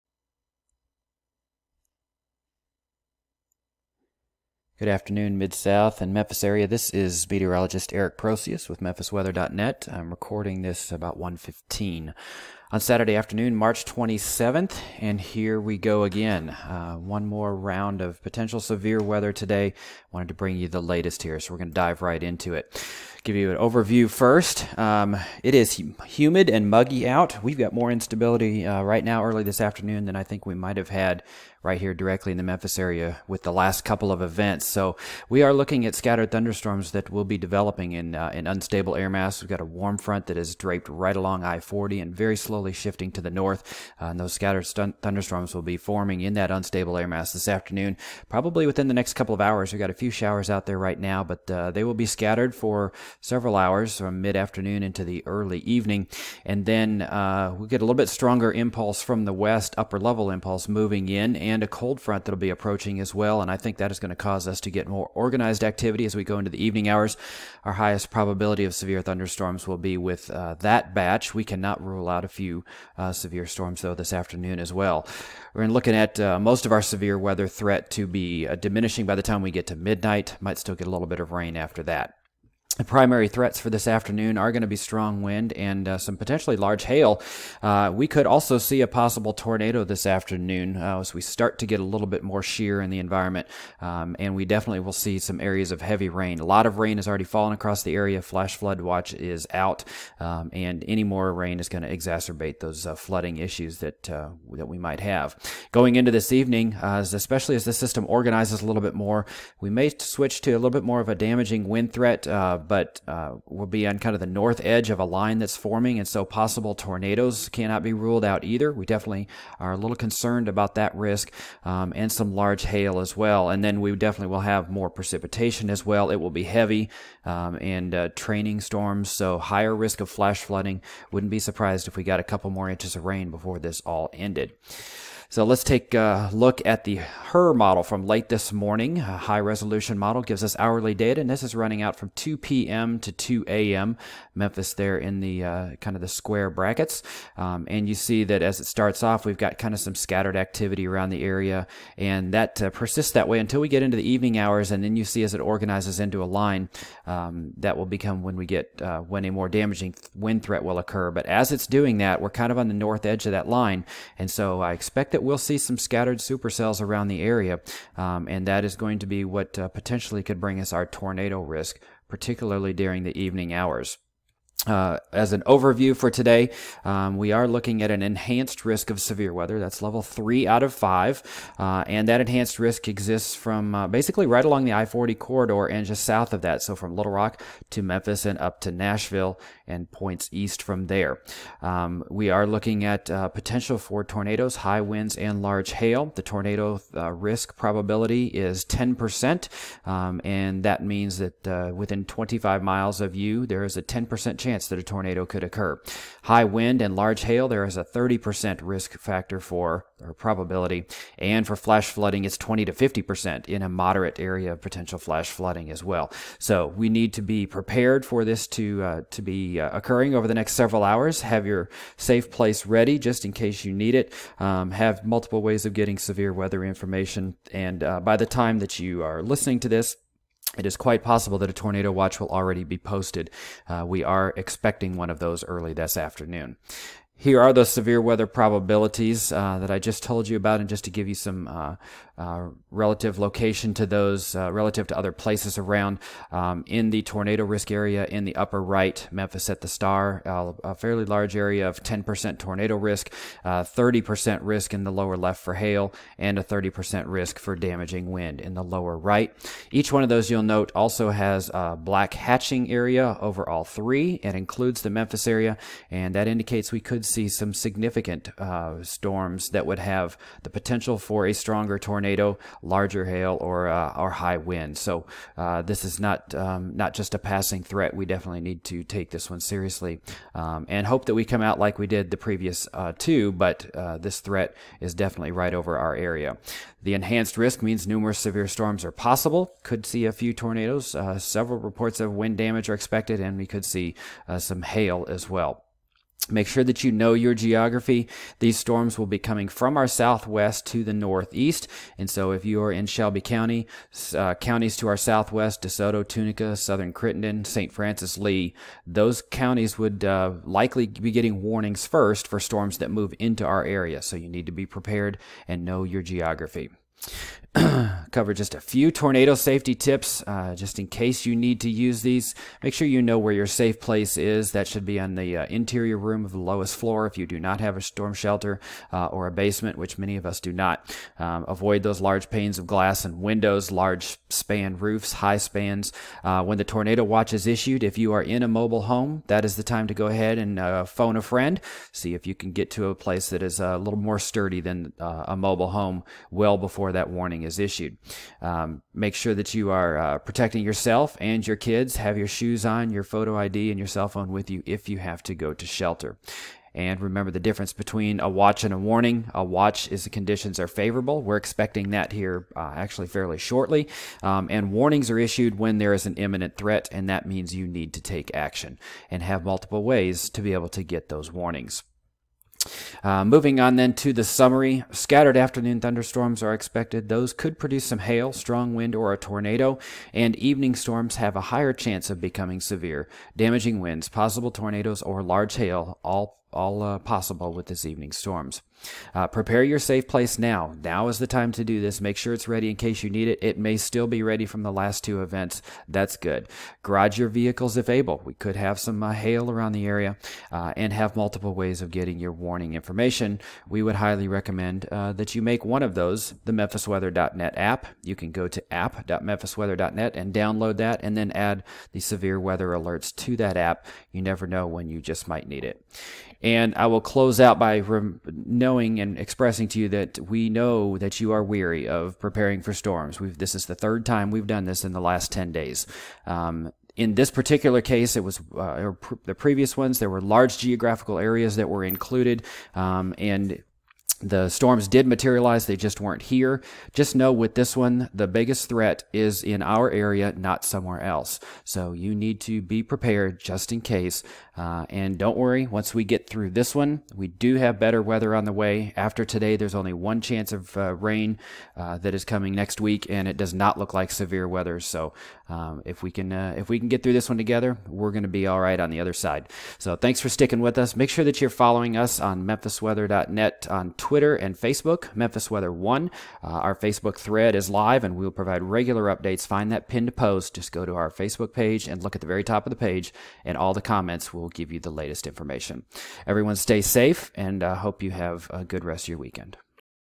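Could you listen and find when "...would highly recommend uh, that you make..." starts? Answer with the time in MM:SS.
06:43.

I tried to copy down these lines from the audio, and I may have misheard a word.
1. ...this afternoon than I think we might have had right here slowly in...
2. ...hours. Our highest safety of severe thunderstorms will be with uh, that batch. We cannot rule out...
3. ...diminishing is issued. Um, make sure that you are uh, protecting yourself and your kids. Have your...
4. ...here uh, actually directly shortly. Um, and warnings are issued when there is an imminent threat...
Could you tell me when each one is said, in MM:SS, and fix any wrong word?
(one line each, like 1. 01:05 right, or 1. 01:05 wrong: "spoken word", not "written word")
1. 00:29 wrong: "directly", not "slowly"
2. 01:06 wrong: "probability", not "safety"
3. 05:47 wrong: "warning", not "diminishing"
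4. 06:02 wrong: "fairly", not "directly".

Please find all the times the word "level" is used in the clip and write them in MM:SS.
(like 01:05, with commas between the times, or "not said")
00:59, 02:59.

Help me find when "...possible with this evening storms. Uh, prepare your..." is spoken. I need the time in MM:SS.
06:26.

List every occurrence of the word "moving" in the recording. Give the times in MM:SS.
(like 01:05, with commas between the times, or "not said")
01:00, 06:13.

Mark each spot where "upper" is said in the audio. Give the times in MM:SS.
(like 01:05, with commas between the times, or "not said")
00:59, 04:08.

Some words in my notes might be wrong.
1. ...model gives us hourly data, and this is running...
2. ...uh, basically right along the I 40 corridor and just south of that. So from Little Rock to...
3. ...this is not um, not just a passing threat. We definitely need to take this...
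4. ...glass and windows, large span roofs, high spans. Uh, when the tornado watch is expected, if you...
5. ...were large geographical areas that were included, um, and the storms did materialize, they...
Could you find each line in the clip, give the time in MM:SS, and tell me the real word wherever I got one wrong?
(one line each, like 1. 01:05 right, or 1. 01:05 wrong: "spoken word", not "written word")
1. 02:19 right
2. 03:03 right
3. 04:35 right
4. 05:32 wrong: "issued", not "expected"
5. 07:10 right.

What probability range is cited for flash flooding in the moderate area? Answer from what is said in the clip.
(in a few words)
20 to 50%.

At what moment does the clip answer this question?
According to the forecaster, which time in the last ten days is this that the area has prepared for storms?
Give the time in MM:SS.
07:03.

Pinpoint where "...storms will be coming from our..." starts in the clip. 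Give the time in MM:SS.
04:58.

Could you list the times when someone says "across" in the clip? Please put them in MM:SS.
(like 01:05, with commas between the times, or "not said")
01:37.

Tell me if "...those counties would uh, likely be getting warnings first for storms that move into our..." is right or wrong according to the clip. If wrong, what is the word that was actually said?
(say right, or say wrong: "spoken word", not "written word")
right.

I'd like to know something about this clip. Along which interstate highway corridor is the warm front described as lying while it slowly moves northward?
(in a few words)
I-40.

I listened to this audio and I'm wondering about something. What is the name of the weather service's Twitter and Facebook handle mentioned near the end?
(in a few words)
Memphis Weather One.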